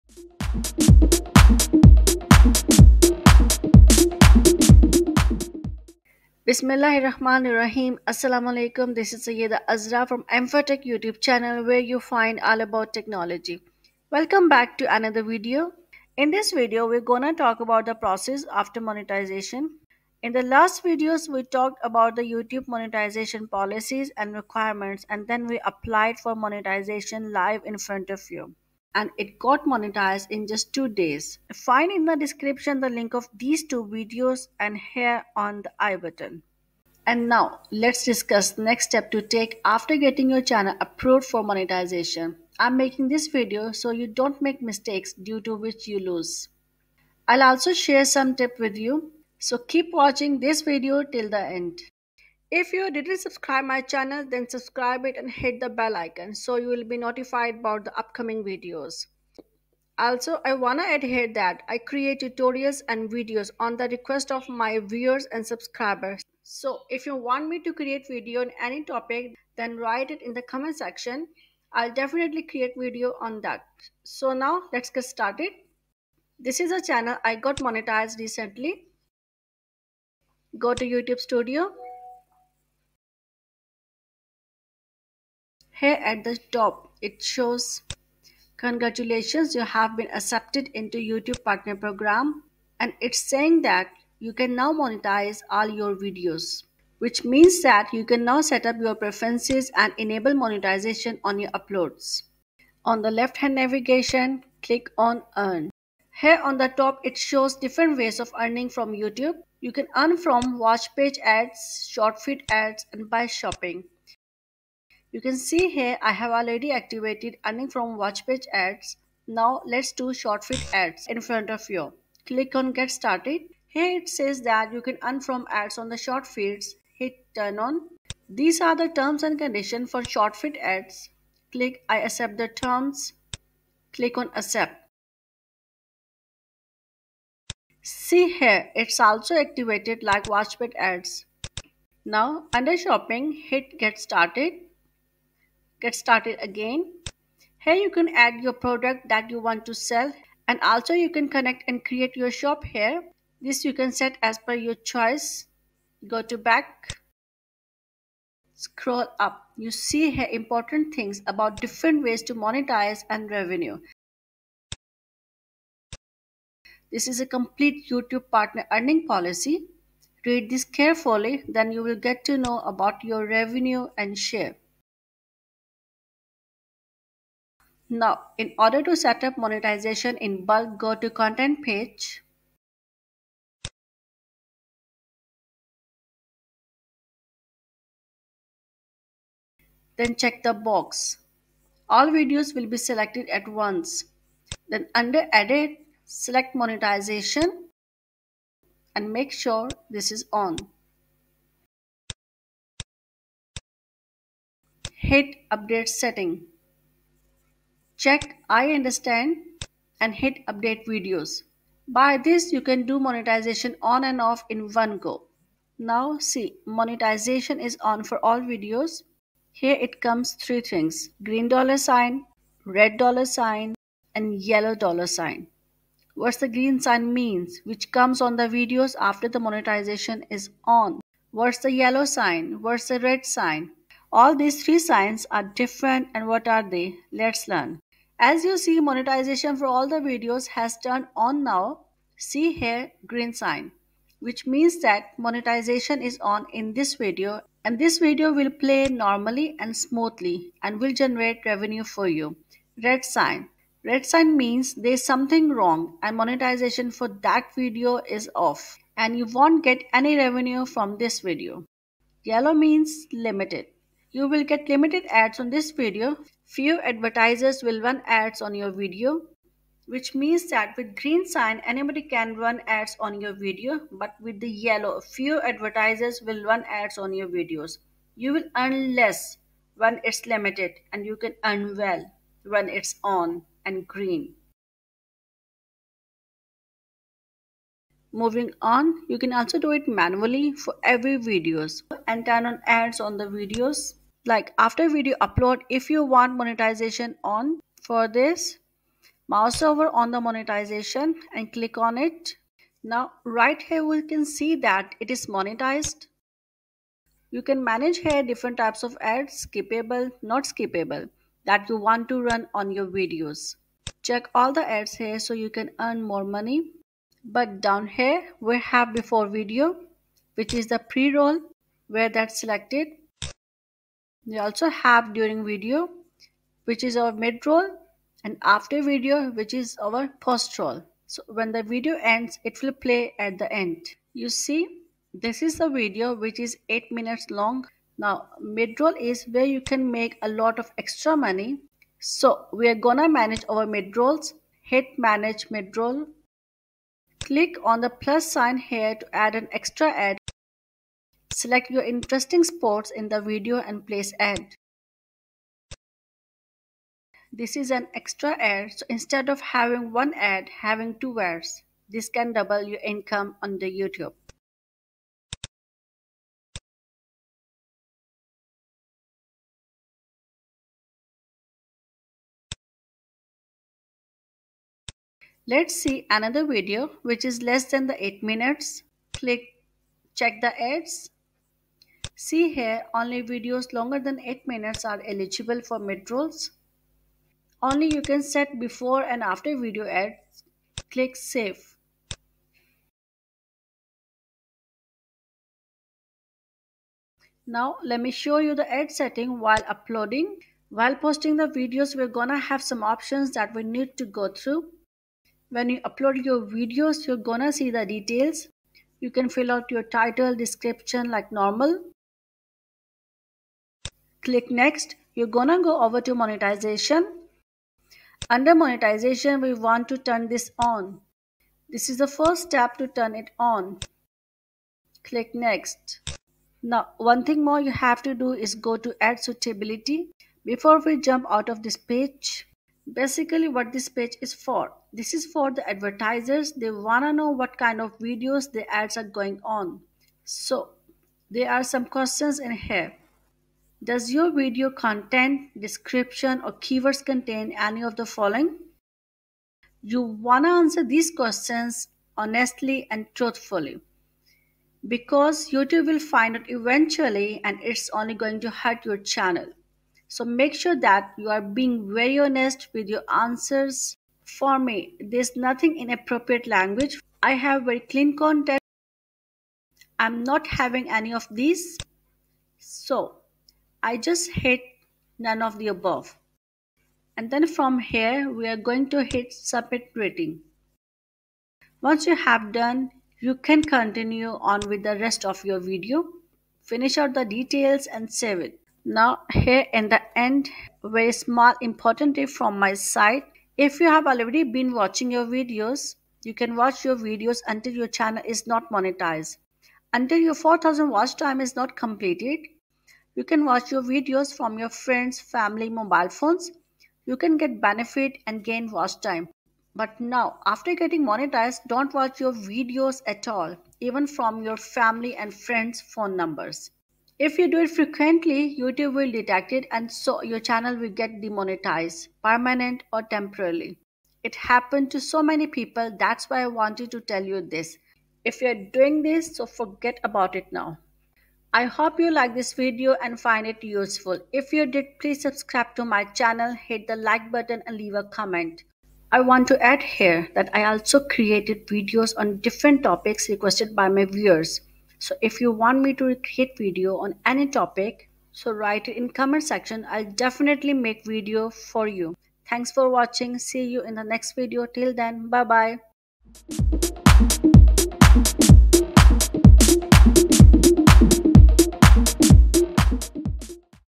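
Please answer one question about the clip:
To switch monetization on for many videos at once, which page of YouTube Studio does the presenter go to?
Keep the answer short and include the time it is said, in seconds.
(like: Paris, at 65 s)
Content page, at 181 s.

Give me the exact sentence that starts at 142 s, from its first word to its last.
Now under shopping, hit get started.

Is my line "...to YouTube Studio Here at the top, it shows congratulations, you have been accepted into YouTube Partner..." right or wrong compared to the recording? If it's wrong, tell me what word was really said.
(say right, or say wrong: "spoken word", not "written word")
right.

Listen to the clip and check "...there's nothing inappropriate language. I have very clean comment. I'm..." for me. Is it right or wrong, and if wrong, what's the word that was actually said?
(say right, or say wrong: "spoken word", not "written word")
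wrong: "content", not "comment".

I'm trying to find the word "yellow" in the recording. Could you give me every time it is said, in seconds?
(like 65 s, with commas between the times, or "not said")
224 s, 231 s, 262 s, 274 s.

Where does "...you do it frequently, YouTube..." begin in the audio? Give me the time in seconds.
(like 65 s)
517 s.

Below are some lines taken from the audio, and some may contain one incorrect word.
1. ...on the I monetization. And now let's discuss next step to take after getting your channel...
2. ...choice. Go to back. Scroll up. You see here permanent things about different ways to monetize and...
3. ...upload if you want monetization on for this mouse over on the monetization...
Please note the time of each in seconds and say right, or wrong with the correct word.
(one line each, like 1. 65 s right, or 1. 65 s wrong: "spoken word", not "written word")
1. 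35 s wrong: "button", not "monetization"
2. 154 s wrong: "important", not "permanent"
3. 295 s right.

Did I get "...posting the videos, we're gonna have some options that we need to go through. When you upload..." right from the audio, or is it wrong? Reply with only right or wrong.
right.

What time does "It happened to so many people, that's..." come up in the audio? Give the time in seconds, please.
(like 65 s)
524 s.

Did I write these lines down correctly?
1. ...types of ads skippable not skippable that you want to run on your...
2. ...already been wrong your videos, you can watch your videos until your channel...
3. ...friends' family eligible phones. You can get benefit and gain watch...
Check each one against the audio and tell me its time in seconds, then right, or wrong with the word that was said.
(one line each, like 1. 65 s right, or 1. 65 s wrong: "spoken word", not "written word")
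1. 308 s right
2. 494 s wrong: "watching", not "wrong"
3. 504 s wrong: "mobile", not "eligible".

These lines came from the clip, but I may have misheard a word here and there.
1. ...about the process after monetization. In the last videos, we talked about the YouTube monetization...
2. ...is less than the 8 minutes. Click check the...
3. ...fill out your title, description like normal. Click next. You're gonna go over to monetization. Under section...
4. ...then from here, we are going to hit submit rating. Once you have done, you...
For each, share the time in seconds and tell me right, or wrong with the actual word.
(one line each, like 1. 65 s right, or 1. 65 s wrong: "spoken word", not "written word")
1. 17 s right
2. 377 s right
3. 409 s wrong: "monetization", not "section"
4. 477 s right.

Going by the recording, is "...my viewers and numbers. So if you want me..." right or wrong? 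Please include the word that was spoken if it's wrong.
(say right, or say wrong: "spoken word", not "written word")
wrong: "subscribers", not "numbers".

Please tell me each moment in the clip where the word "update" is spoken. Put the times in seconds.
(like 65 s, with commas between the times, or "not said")
205 s, 210 s.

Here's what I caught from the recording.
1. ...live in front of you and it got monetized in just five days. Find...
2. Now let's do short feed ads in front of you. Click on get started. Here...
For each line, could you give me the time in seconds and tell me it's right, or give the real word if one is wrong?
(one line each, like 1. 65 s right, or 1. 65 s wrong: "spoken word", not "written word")
1. 27 s wrong: "two", not "five"
2. 119 s right.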